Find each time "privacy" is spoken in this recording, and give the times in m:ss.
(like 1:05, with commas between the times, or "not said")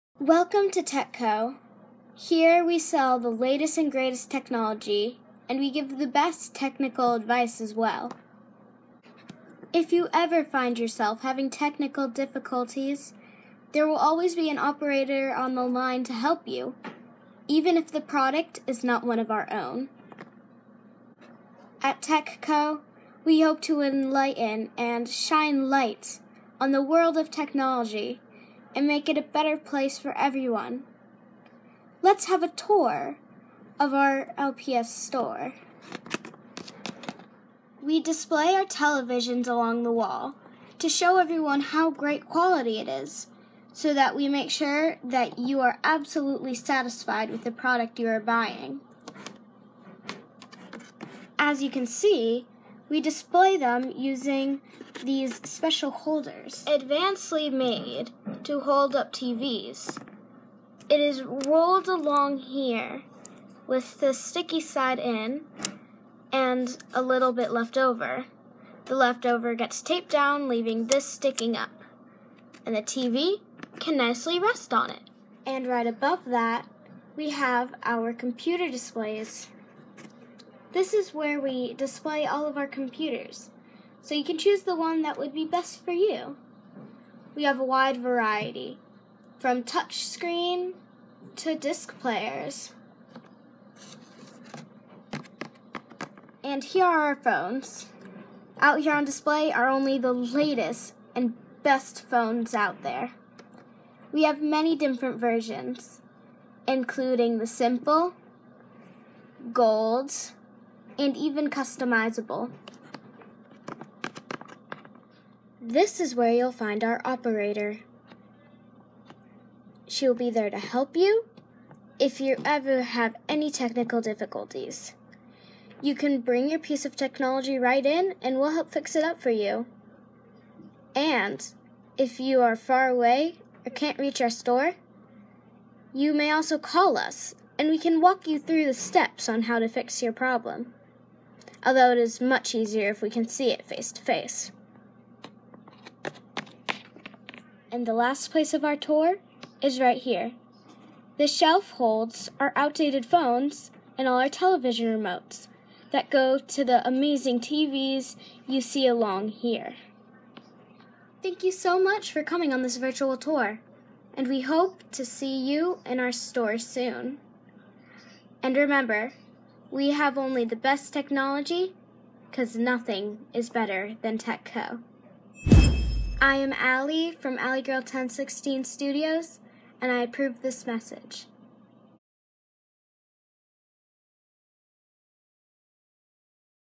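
not said.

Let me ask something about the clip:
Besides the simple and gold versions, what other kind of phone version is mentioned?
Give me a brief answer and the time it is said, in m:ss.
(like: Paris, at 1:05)
Customizable, at 1:51.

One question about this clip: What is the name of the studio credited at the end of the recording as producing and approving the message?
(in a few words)
Ally Girl 1016 Studios.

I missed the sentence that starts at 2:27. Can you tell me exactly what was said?
And the last place of our tour is right here.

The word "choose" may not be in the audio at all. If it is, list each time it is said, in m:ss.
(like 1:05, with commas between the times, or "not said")
1:24.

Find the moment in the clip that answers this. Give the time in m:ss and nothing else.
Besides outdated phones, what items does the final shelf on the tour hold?
2:34.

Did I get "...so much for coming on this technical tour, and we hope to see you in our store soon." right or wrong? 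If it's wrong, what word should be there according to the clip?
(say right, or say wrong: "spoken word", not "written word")
wrong: "virtual", not "technical".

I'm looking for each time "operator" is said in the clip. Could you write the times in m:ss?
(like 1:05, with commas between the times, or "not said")
0:14, 1:57.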